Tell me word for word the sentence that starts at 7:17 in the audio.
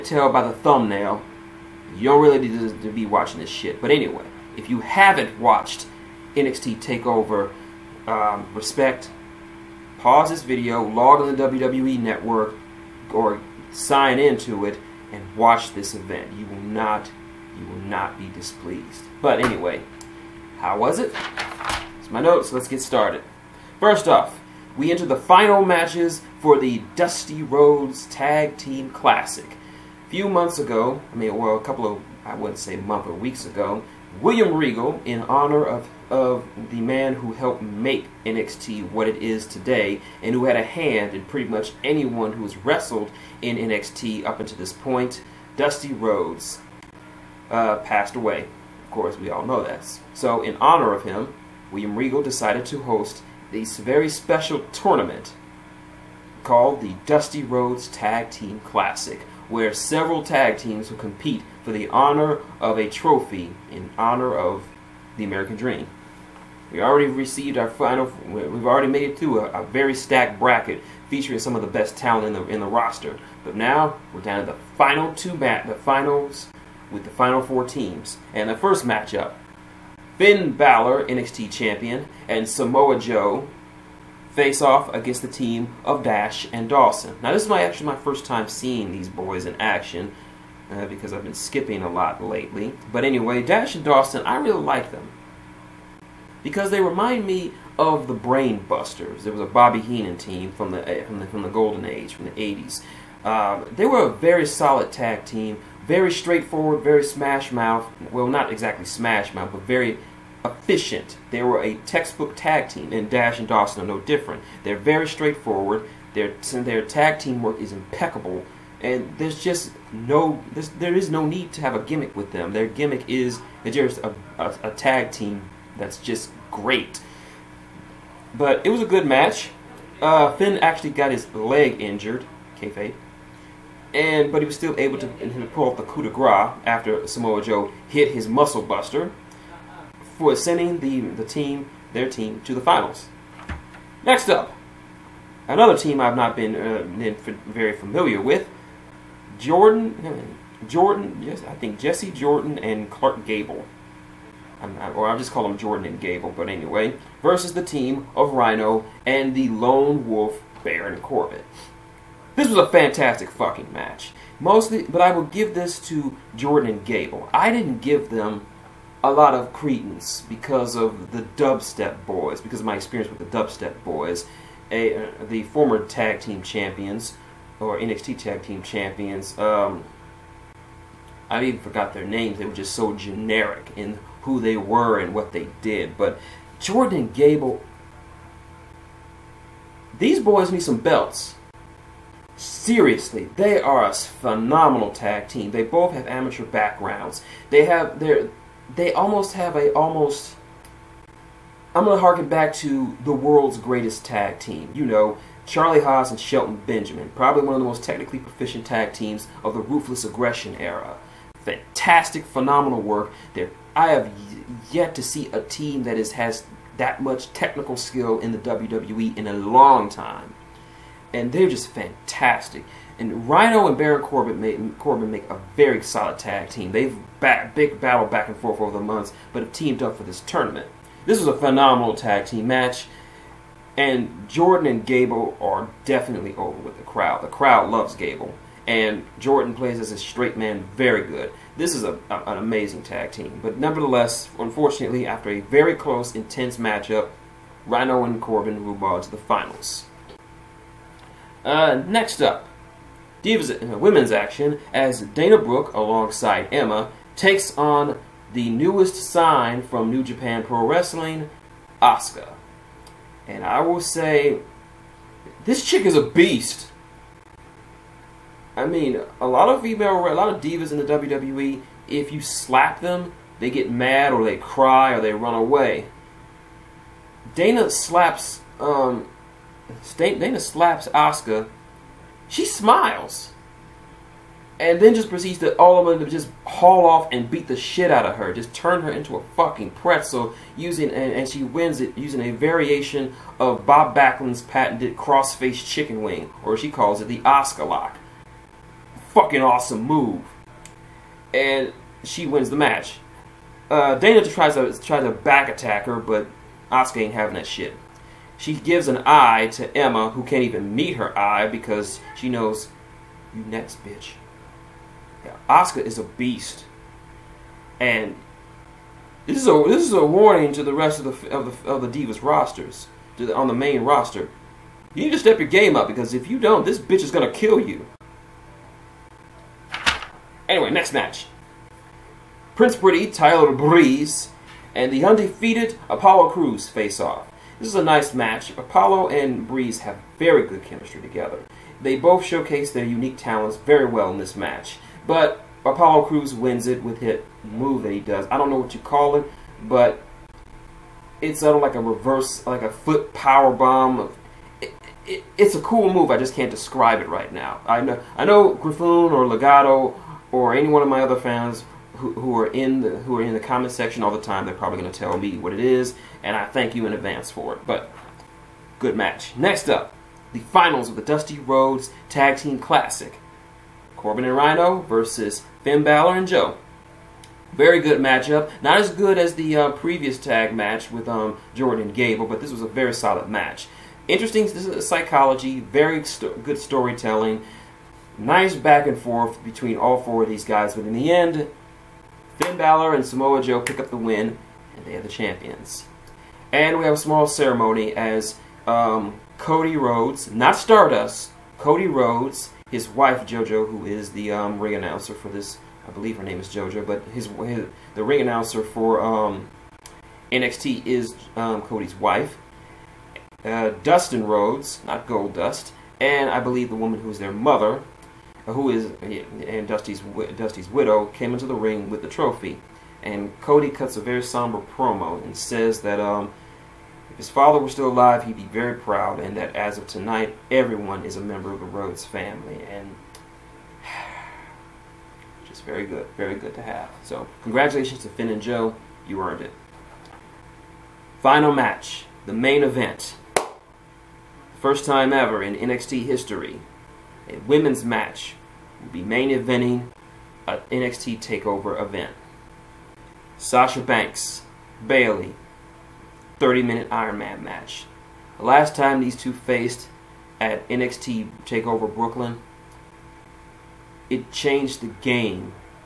So congratulations to Finn and Joe, you earned it.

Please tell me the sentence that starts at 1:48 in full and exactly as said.
Well, not exactly smash mouth, but very efficient.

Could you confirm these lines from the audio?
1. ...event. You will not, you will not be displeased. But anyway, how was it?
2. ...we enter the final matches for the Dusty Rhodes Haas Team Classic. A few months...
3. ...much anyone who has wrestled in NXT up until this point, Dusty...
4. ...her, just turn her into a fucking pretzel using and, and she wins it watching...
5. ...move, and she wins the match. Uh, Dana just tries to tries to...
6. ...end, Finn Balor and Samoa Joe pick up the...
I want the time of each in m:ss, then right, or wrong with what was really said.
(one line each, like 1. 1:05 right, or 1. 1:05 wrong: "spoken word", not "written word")
1. 0:15 right
2. 0:24 wrong: "Tag", not "Haas"
3. 0:41 right
4. 4:48 wrong: "using", not "watching"
5. 4:59 right
6. 6:31 right.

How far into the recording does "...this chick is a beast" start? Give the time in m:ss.
4:25.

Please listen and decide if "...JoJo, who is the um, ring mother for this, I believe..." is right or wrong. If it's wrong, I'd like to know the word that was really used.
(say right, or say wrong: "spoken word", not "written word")
wrong: "announcer", not "mother".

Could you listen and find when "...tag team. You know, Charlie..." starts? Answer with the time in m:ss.
3:24.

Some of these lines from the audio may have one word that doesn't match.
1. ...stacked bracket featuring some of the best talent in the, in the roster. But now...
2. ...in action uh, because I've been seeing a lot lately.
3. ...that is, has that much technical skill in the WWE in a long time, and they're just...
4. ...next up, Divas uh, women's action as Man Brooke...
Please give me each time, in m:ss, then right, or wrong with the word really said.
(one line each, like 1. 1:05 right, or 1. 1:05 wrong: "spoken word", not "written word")
1. 1:09 right
2. 1:29 wrong: "skipping", not "seeing"
3. 3:35 right
4. 4:11 wrong: "Dana", not "Man".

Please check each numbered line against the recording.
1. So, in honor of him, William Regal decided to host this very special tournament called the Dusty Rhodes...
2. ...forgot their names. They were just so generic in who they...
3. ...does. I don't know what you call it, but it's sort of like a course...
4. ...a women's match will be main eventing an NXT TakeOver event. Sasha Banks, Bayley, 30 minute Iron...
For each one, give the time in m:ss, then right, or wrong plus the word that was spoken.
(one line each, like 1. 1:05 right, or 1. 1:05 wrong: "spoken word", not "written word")
1. 0:50 right
2. 3:01 right
3. 5:48 wrong: "reverse", not "course"
4. 7:27 right.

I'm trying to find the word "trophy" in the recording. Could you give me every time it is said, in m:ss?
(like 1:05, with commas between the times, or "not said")
1:02, 7:02.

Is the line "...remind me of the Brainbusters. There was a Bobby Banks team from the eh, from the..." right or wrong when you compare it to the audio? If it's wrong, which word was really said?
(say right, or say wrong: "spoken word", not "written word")
wrong: "Heenan", not "Banks".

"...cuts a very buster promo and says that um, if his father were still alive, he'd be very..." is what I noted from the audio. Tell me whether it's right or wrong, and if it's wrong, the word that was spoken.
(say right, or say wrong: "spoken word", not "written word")
wrong: "somber", not "buster".